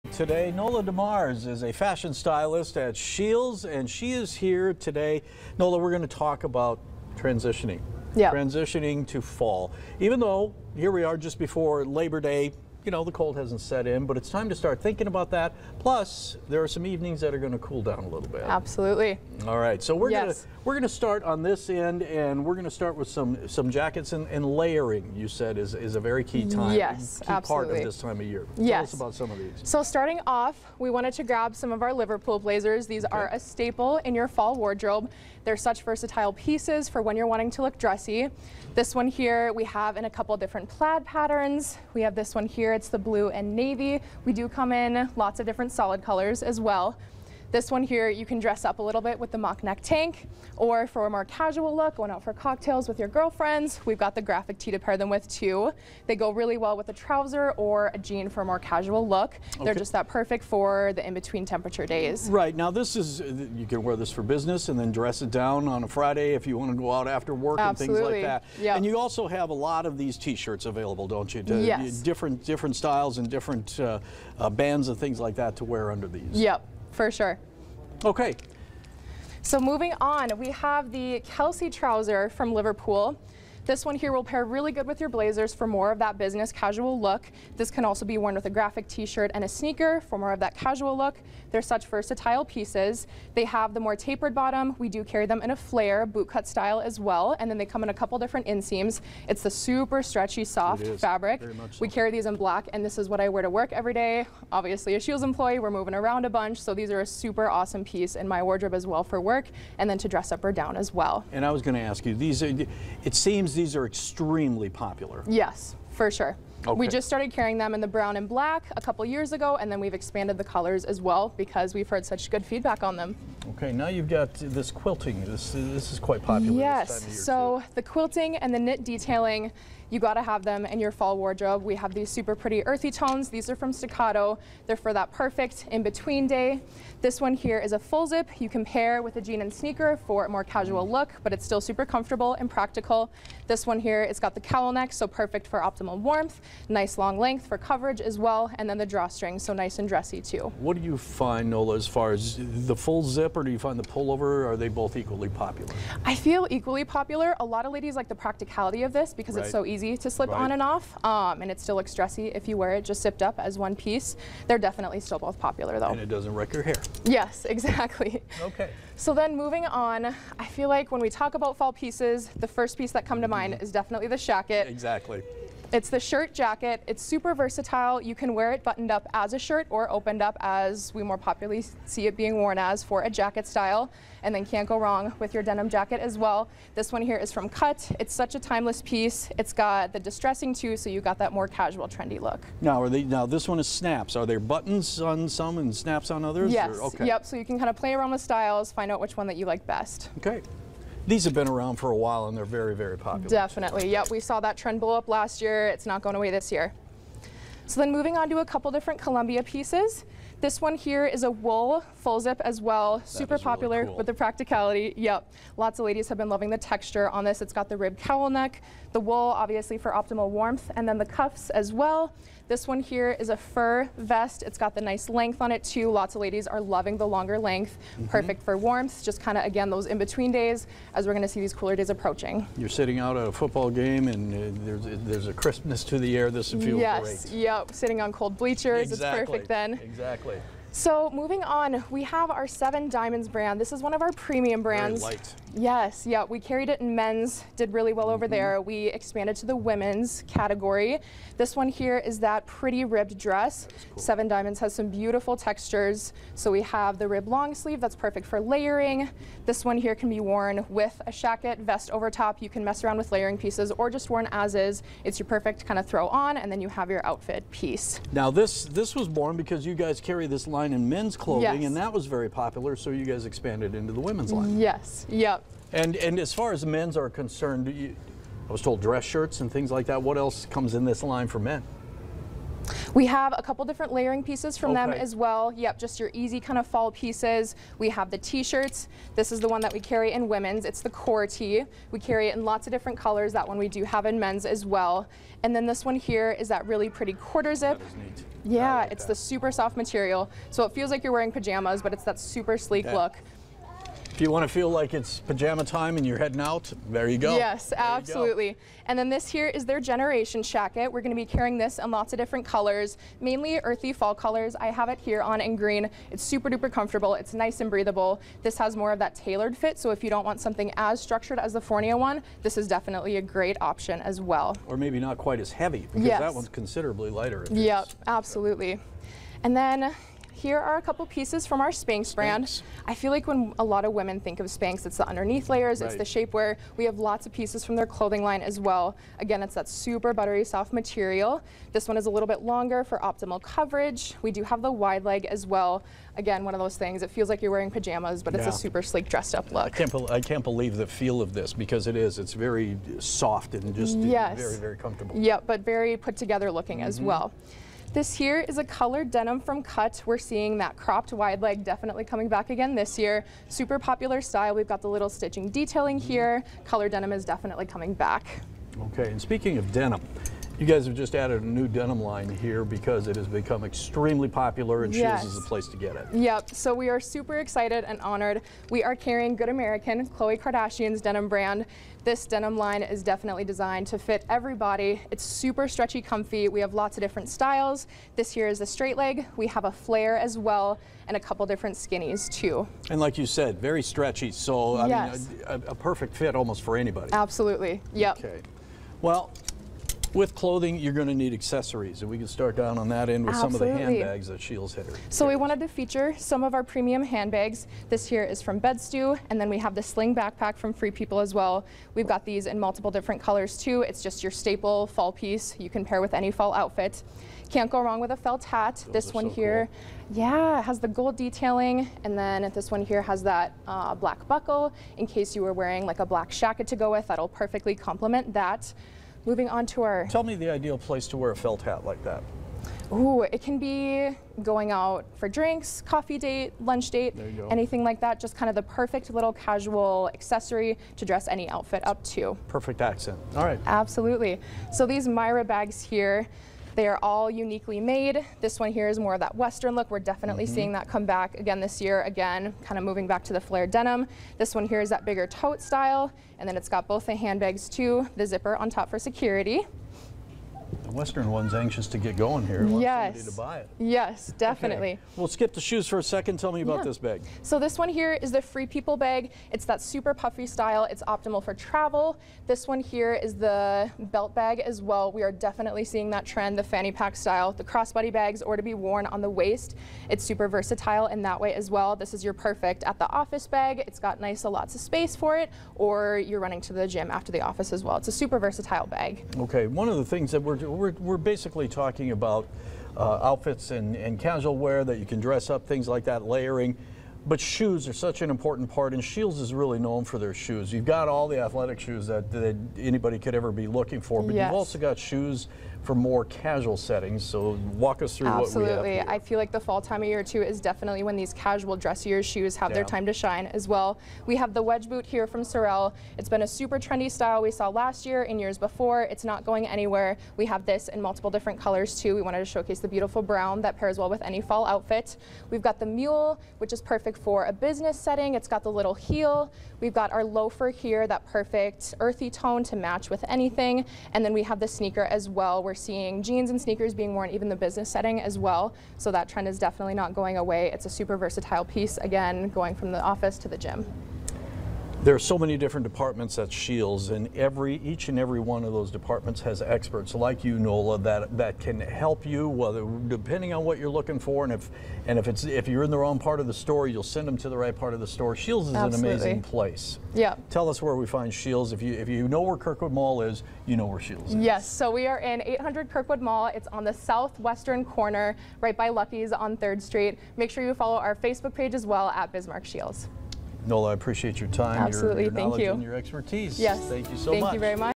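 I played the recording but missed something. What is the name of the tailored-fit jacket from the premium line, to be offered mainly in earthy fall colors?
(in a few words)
Generation jacket.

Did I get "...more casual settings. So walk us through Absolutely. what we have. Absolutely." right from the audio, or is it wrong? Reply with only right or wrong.
right.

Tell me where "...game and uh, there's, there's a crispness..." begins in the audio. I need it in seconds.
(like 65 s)
233 s.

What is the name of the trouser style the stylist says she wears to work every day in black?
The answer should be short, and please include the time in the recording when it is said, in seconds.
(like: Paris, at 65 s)
Kelsey, at 81 s.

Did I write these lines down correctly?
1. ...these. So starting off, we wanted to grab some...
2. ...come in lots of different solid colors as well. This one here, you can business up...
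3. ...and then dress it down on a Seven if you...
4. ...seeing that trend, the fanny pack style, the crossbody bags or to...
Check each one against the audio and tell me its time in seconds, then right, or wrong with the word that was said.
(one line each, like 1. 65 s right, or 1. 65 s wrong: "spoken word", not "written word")
1. 29 s right
2. 44 s wrong: "dress", not "business"
3. 64 s wrong: "Friday", not "Seven"
4. 475 s right.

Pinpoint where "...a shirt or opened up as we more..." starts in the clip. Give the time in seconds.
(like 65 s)
179 s.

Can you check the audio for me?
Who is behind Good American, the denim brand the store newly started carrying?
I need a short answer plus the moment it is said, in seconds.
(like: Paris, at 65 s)
Khloe Kardashian, at 380 s.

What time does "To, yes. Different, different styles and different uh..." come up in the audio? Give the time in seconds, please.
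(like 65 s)
71 s.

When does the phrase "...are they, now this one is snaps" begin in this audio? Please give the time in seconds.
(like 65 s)
192 s.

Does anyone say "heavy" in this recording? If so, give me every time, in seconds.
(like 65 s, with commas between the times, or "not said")
325 s.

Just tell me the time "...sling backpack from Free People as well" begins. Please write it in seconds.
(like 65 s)
409 s.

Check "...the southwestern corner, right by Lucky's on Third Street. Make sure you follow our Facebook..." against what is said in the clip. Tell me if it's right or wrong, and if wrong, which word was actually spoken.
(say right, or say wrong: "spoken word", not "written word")
right.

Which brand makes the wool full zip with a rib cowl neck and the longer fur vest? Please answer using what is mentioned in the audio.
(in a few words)
Columbia.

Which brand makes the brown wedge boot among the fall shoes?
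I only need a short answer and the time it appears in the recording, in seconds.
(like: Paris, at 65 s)
Sorel, at 515 s.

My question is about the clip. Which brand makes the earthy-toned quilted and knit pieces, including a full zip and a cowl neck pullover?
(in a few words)
Staccato.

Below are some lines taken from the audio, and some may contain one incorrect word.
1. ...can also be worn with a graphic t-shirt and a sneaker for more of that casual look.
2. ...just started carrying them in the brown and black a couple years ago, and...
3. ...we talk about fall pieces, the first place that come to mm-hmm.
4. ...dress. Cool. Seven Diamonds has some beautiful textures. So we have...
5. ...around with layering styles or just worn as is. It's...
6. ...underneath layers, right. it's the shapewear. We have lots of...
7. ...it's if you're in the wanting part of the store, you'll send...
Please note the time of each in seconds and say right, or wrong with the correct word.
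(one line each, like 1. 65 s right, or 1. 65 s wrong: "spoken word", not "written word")
1. 87 s right
2. 116 s right
3. 171 s wrong: "piece", not "place"
4. 253 s right
5. 262 s wrong: "pieces", not "styles"
6. 335 s right
7. 555 s wrong: "wrong", not "wanting".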